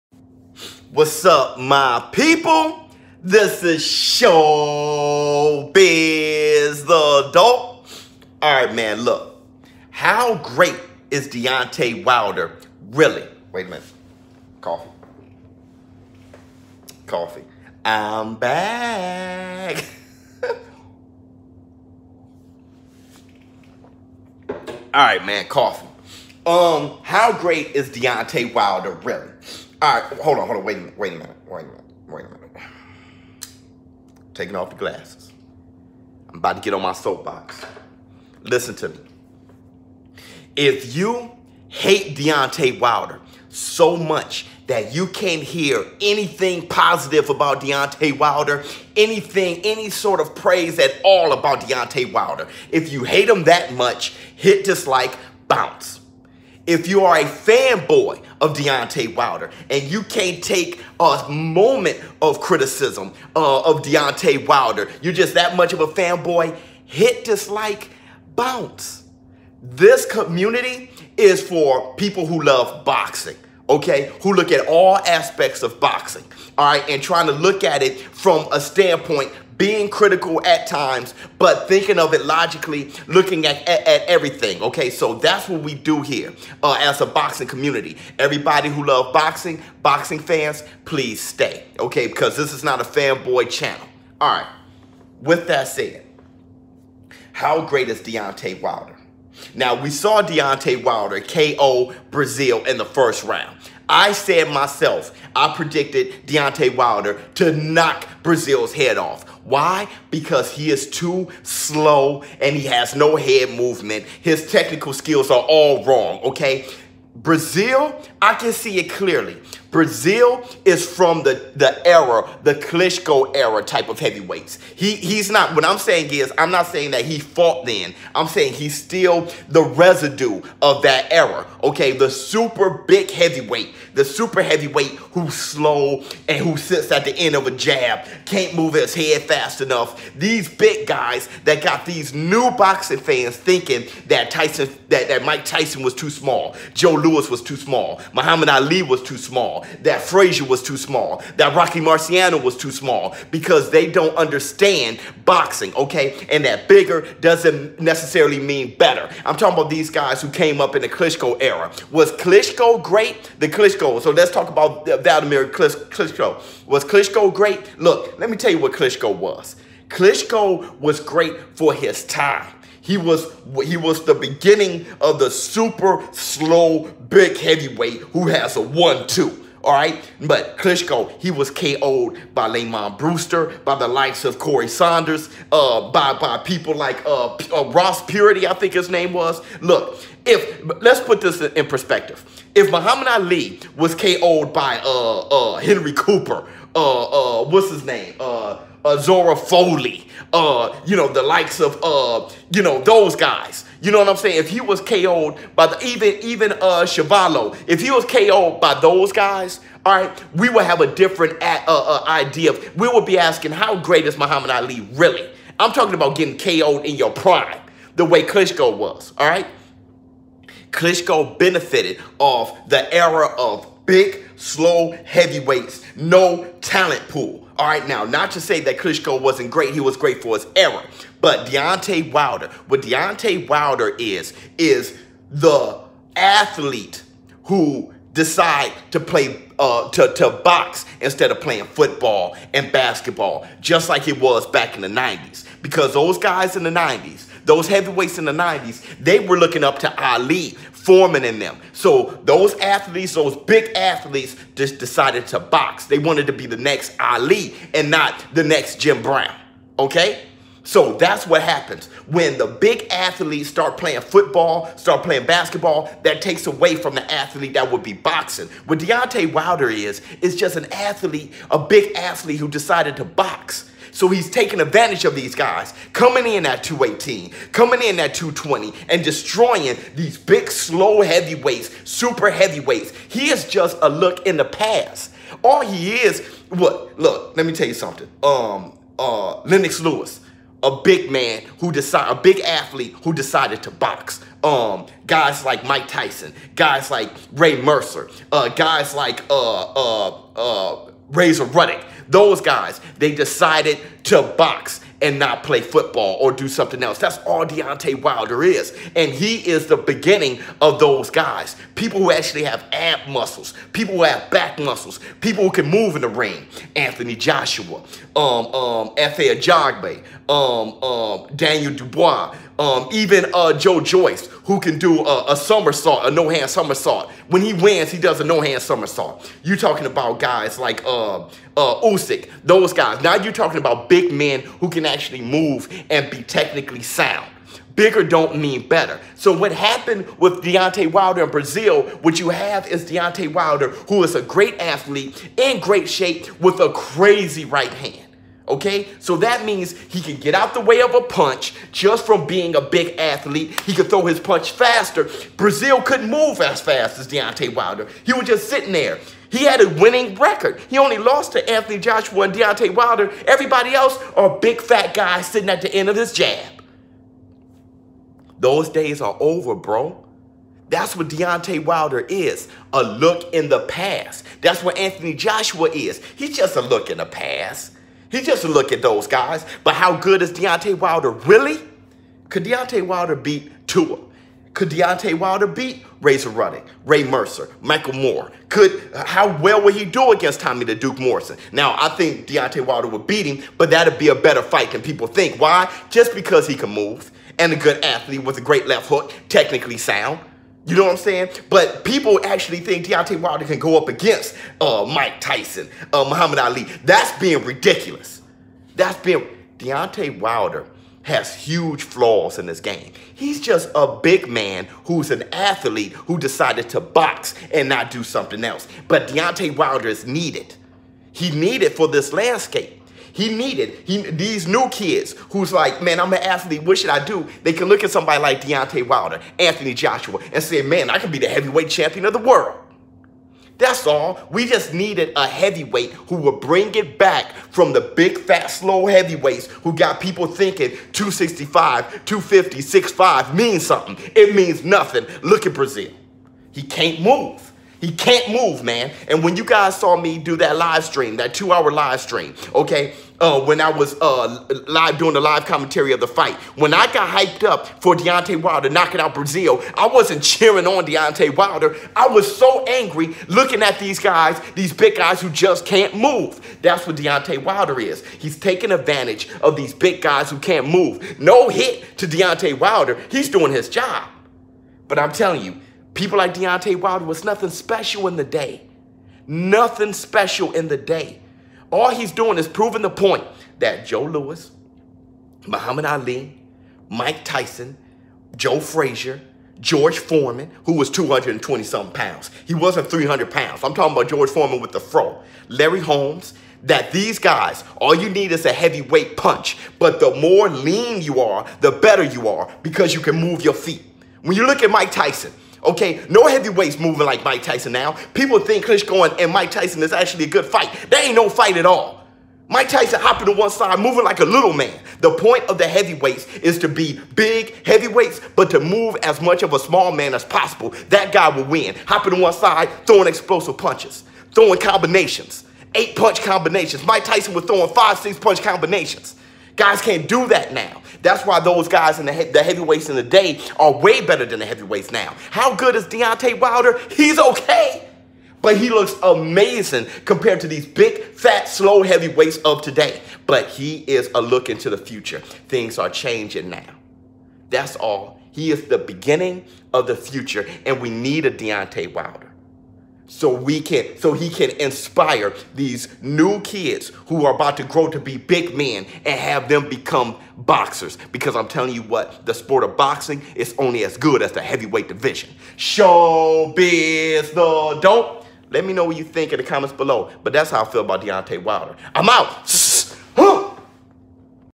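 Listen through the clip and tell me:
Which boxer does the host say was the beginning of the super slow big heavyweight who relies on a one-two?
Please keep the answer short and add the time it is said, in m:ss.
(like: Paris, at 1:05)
Vladimir Klitschko, at 2:44.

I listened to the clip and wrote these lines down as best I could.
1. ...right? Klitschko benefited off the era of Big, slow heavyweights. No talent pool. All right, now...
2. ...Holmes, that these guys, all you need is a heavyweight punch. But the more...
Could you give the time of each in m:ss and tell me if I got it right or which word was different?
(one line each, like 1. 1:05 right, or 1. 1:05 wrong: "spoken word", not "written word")
1. 3:39 right
2. 8:15 right.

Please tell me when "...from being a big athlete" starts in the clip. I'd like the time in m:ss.
5:52.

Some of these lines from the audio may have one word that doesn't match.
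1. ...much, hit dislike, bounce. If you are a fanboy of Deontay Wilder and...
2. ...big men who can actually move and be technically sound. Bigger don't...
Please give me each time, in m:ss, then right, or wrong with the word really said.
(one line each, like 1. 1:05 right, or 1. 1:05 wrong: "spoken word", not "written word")
1. 0:53 right
2. 5:33 right.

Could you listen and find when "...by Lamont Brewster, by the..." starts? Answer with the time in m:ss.
3:02.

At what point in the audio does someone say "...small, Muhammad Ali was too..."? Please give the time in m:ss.
2:27.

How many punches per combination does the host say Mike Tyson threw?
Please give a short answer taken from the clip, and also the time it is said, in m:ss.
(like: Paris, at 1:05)
5 or 6, at 8:47.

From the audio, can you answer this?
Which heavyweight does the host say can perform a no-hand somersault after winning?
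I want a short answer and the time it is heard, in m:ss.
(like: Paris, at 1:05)
Joe Joyce, at 5:23.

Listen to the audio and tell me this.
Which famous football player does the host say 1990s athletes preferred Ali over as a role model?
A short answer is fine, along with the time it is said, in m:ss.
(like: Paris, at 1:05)
Jim Brown, at 4:18.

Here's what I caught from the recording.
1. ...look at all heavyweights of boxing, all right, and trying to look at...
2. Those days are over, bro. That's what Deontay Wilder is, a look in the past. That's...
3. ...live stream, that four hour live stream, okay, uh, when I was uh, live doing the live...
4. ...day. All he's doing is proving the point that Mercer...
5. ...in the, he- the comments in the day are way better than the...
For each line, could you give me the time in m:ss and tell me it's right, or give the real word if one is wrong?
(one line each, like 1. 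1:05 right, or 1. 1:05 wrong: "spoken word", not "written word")
1. 1:14 wrong: "aspects", not "heavyweights"
2. 6:08 right
3. 7:30 wrong: "two", not "four"
4. 8:00 wrong: "Joe", not "Mercer"
5. 8:51 wrong: "heavyweights", not "comments".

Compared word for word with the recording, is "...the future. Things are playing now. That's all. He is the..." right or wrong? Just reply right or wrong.
wrong.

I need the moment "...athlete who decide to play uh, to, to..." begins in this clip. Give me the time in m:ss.
3:56.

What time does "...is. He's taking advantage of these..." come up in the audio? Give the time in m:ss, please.
7:47.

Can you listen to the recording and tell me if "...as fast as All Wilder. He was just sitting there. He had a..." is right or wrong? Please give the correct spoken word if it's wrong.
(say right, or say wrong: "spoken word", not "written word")
wrong: "Deontay", not "All".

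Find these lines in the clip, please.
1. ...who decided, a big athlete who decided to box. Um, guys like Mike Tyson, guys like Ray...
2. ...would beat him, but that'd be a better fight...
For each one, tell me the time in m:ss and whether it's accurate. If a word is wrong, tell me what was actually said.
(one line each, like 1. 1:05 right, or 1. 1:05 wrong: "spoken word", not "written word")
1. 4:51 right
2. 6:32 right.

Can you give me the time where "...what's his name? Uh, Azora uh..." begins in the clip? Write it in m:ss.
3:17.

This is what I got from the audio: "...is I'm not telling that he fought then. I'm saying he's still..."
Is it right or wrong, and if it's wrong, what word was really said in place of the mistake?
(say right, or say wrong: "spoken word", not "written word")
wrong: "saying", not "telling".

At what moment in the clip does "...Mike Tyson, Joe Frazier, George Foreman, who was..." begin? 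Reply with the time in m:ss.
8:06.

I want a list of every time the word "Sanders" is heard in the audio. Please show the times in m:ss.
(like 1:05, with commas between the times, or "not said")
3:04.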